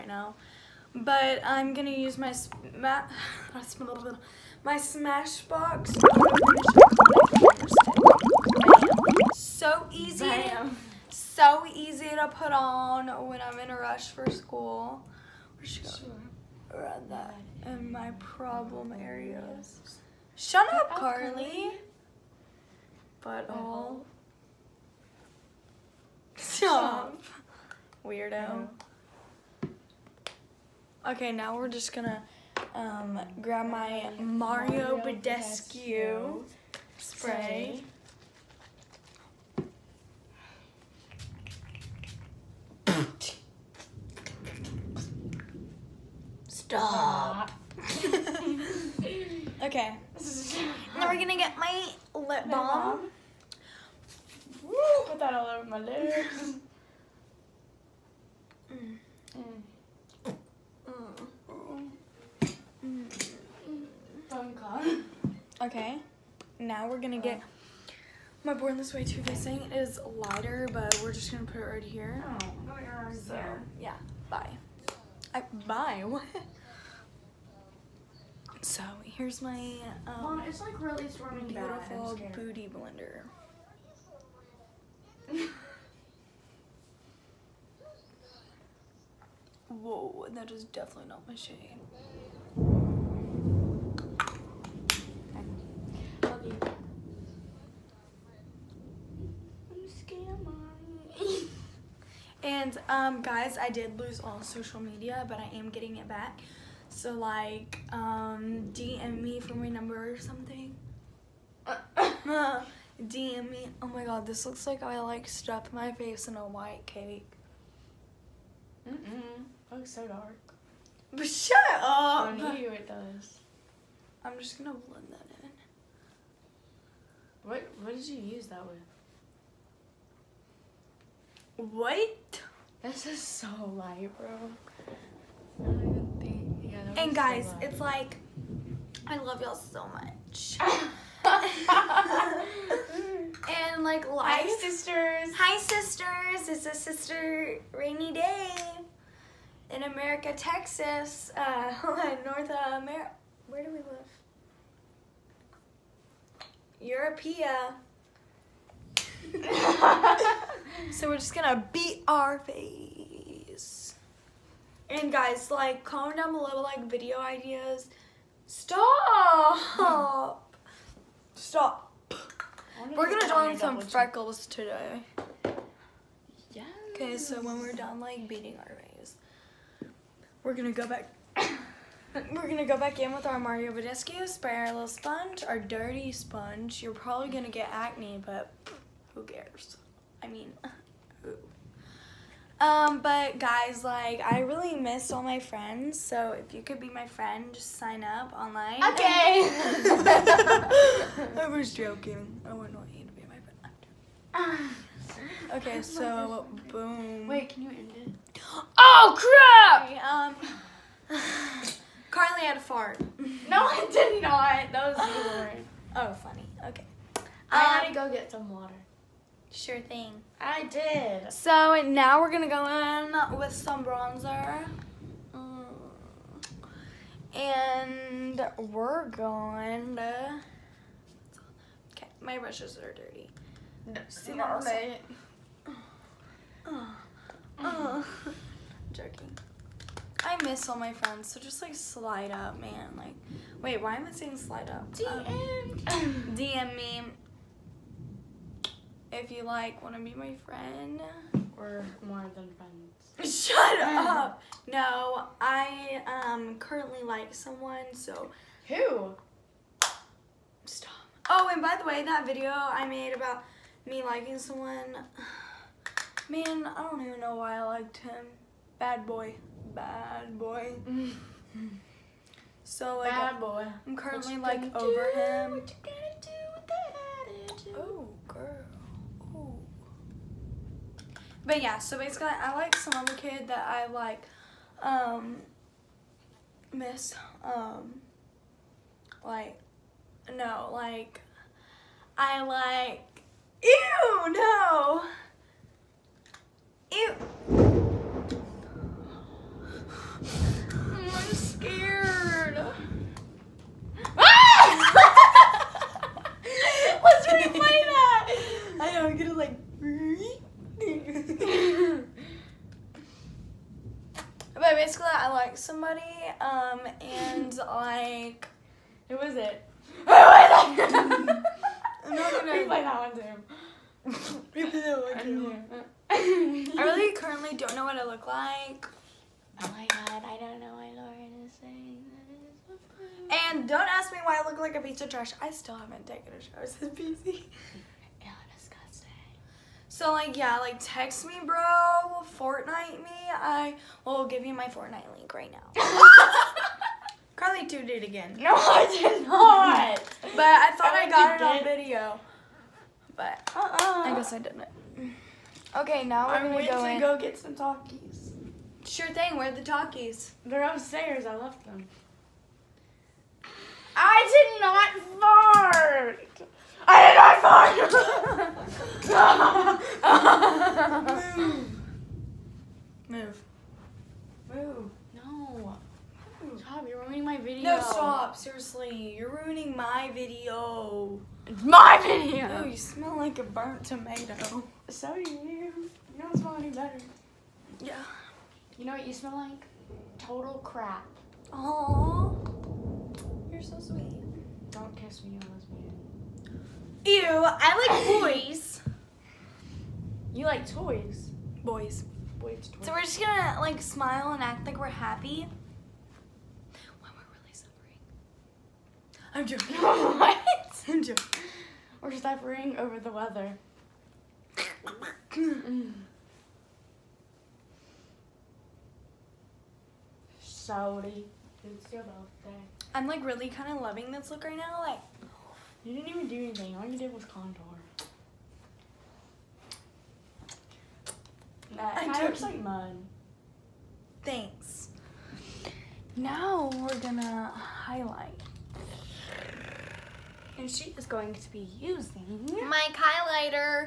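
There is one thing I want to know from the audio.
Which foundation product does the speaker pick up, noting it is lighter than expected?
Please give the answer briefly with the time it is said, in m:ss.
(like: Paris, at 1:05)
Born This Way, at 1:08.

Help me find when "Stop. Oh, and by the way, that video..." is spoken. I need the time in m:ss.
4:20.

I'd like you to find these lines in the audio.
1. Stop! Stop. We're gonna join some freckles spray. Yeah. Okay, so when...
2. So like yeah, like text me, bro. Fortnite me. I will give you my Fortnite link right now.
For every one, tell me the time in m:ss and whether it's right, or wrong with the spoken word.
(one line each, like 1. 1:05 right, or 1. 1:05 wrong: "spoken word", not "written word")
1. 2:48 wrong: "today", not "spray"
2. 5:40 right.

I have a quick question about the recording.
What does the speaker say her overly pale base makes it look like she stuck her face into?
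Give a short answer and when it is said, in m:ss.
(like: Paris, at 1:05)
a white cake, at 1:56.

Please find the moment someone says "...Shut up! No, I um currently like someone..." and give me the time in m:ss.
4:13.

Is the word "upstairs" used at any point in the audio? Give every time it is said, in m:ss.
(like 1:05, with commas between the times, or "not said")
6:00.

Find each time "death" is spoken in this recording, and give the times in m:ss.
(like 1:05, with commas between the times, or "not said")
not said.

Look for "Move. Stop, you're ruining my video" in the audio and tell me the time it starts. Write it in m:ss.
6:16.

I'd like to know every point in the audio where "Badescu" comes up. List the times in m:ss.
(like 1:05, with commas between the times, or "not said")
0:34, 3:03.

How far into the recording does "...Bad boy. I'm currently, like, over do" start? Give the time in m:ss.
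4:33.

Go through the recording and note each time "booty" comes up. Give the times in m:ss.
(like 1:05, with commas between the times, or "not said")
1:22.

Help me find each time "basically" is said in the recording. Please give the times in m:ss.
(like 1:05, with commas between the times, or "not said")
4:41, 5:14.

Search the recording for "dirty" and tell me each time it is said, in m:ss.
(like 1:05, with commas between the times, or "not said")
3:05, 3:52.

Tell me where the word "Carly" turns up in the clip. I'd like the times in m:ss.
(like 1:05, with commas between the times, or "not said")
0:20, 3:32, 5:47.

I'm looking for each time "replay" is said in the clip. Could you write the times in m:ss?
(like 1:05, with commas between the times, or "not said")
5:07, 5:22.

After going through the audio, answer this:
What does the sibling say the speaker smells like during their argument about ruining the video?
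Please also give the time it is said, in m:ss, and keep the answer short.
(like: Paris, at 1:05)
a burnt tomato, at 6:23.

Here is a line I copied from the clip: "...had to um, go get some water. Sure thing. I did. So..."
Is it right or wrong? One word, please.
right.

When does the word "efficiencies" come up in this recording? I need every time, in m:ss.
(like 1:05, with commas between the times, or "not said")
not said.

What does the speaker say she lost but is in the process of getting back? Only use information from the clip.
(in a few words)
social media.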